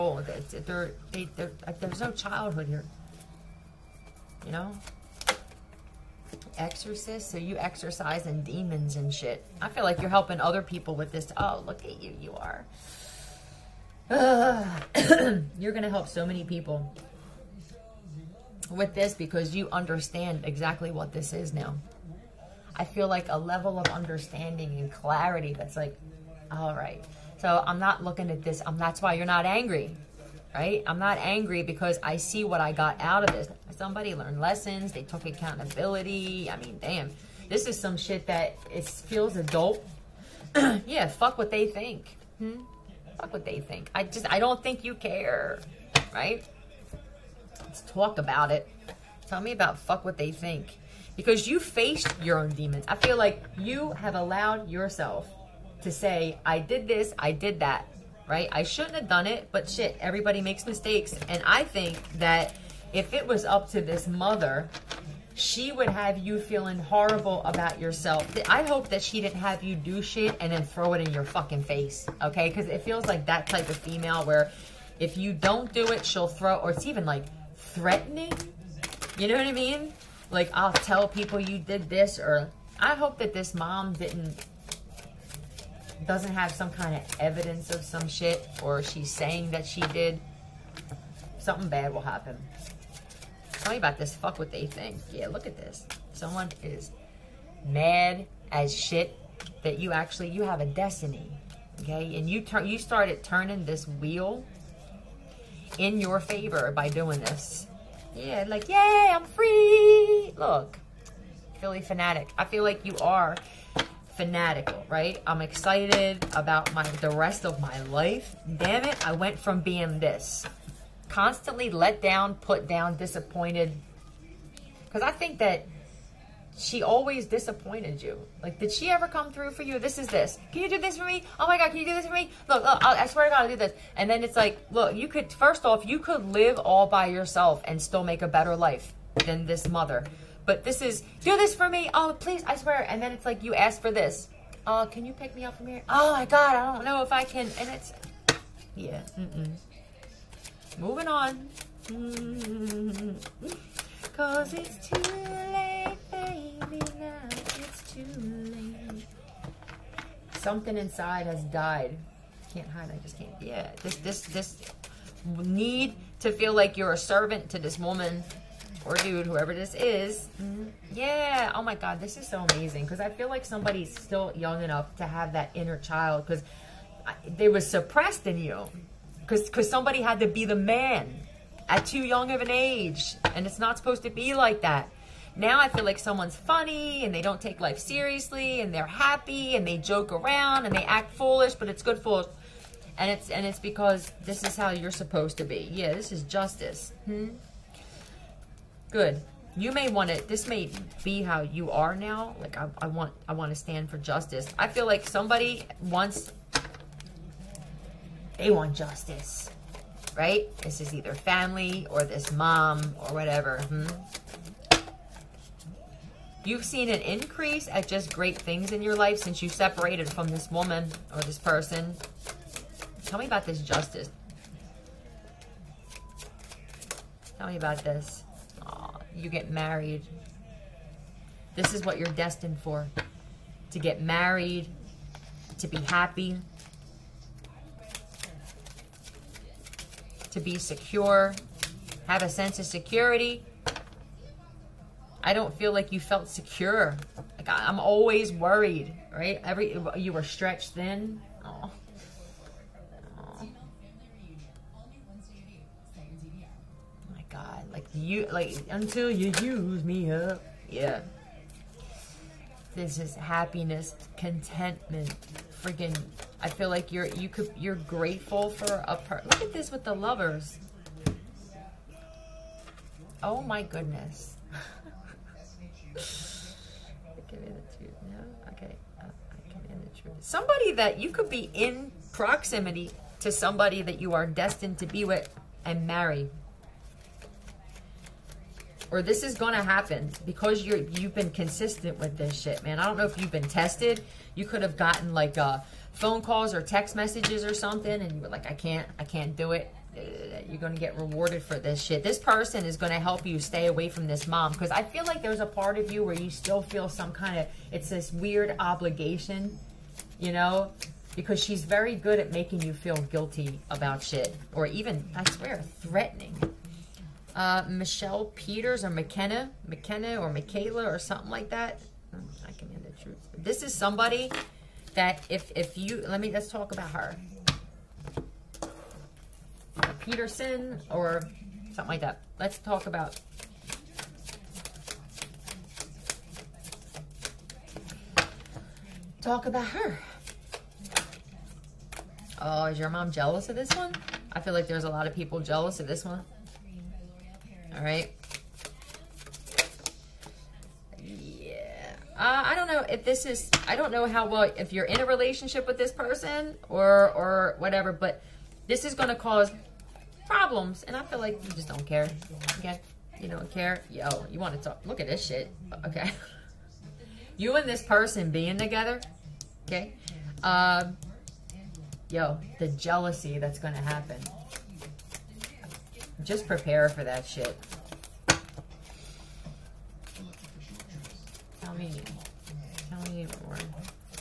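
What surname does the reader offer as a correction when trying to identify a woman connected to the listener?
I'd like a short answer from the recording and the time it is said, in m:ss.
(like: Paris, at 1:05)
Peterson, at 5:29.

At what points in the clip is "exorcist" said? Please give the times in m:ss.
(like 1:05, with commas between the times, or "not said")
0:06.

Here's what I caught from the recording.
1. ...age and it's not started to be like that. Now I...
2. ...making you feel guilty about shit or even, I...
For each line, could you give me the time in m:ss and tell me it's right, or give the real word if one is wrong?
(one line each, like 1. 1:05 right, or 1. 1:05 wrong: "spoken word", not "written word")
1. 3:02 wrong: "supposed", not "started"
2. 5:12 right.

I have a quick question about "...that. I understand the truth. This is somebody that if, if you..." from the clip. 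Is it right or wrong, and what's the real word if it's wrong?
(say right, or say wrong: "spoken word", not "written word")
wrong: "command", not "understand".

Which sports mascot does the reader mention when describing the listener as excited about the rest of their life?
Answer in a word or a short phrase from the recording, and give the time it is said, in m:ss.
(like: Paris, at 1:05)
Philly Fanatic, at 1:51.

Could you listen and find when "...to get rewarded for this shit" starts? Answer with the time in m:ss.
5:00.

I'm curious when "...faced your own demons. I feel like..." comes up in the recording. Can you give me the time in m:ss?
0:51.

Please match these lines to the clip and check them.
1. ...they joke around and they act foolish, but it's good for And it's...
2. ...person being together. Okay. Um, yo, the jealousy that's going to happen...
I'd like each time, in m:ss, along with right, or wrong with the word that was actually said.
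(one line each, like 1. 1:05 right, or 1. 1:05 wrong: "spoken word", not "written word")
1. 3:09 right
2. 6:07 right.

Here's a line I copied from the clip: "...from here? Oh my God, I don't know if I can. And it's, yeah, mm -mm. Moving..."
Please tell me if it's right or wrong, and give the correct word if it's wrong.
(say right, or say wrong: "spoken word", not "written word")
right.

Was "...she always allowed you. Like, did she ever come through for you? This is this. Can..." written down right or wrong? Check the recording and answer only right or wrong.
wrong.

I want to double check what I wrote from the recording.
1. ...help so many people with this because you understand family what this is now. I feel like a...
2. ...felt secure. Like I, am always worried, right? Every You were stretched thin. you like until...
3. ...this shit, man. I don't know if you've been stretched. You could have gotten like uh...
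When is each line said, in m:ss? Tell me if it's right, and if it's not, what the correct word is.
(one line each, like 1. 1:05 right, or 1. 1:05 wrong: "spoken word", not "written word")
1. 0:15 wrong: "exactly", not "family"
2. 4:06 right
3. 4:52 wrong: "tested", not "stretched".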